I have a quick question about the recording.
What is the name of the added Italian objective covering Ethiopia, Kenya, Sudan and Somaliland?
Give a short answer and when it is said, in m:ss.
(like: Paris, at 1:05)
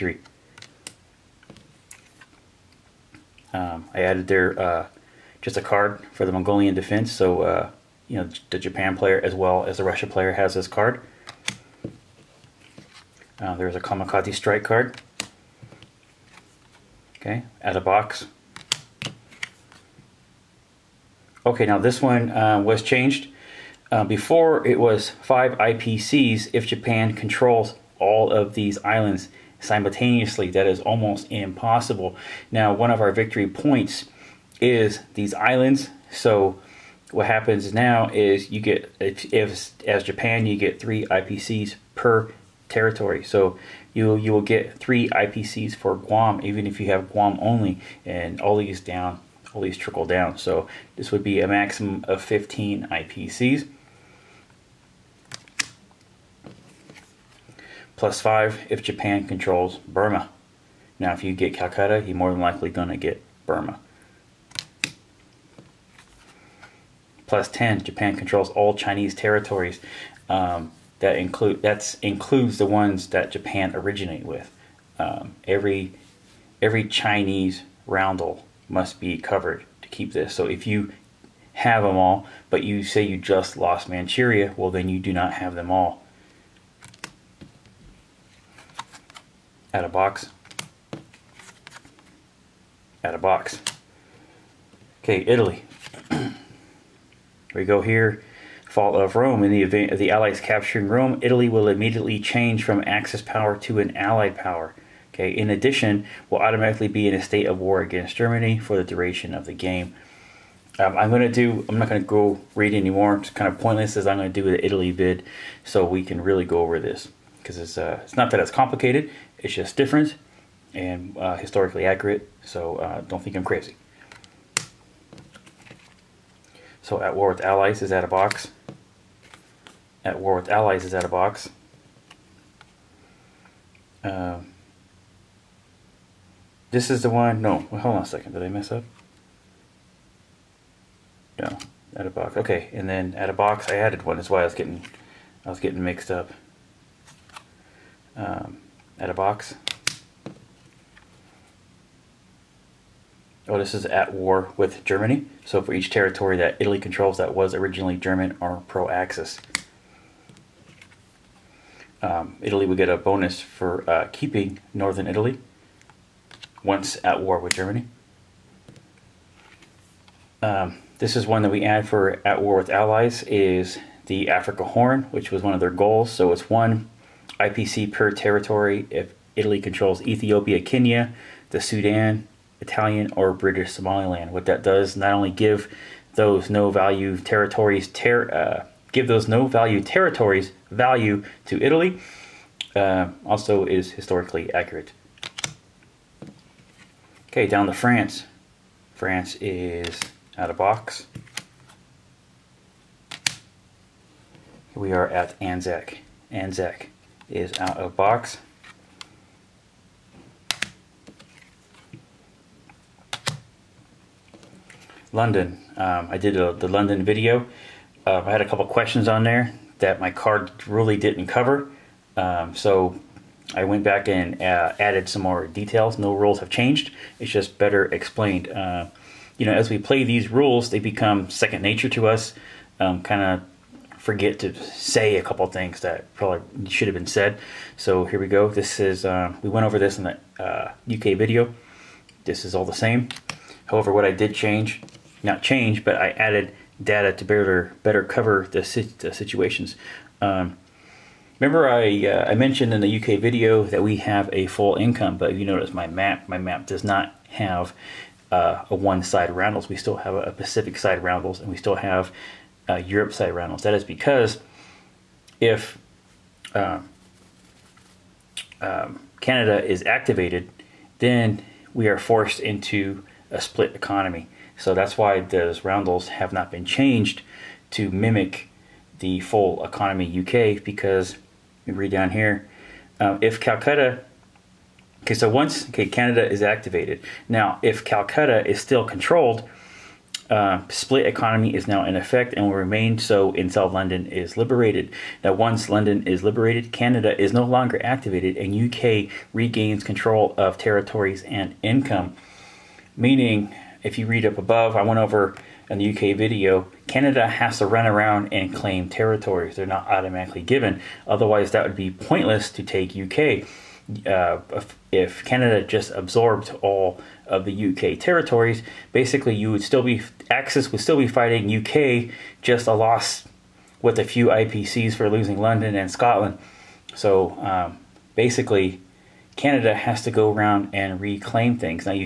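Africa Horn, at 2:54.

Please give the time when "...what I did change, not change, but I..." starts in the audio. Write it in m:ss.
4:03.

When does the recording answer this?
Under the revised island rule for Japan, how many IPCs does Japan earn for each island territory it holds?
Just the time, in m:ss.
0:40.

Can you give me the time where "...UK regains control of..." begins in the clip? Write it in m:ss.
4:58.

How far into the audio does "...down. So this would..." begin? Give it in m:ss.
0:50.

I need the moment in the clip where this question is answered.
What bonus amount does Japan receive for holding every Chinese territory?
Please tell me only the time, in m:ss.
1:07.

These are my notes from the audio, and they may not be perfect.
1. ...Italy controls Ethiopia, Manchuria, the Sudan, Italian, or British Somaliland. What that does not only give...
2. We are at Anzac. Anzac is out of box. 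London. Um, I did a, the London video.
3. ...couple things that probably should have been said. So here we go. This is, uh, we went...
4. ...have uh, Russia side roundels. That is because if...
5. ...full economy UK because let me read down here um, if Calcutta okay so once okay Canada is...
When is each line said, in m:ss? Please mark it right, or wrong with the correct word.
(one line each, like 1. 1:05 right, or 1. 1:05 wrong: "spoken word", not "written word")
1. 2:59 wrong: "Kenya", not "Manchuria"
2. 3:24 right
3. 3:55 right
4. 4:21 wrong: "Europe", not "Russia"
5. 4:39 right.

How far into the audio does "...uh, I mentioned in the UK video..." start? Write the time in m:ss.
4:12.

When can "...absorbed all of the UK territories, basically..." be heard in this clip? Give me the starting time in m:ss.
5:15.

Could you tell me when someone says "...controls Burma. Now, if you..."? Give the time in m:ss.
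0:59.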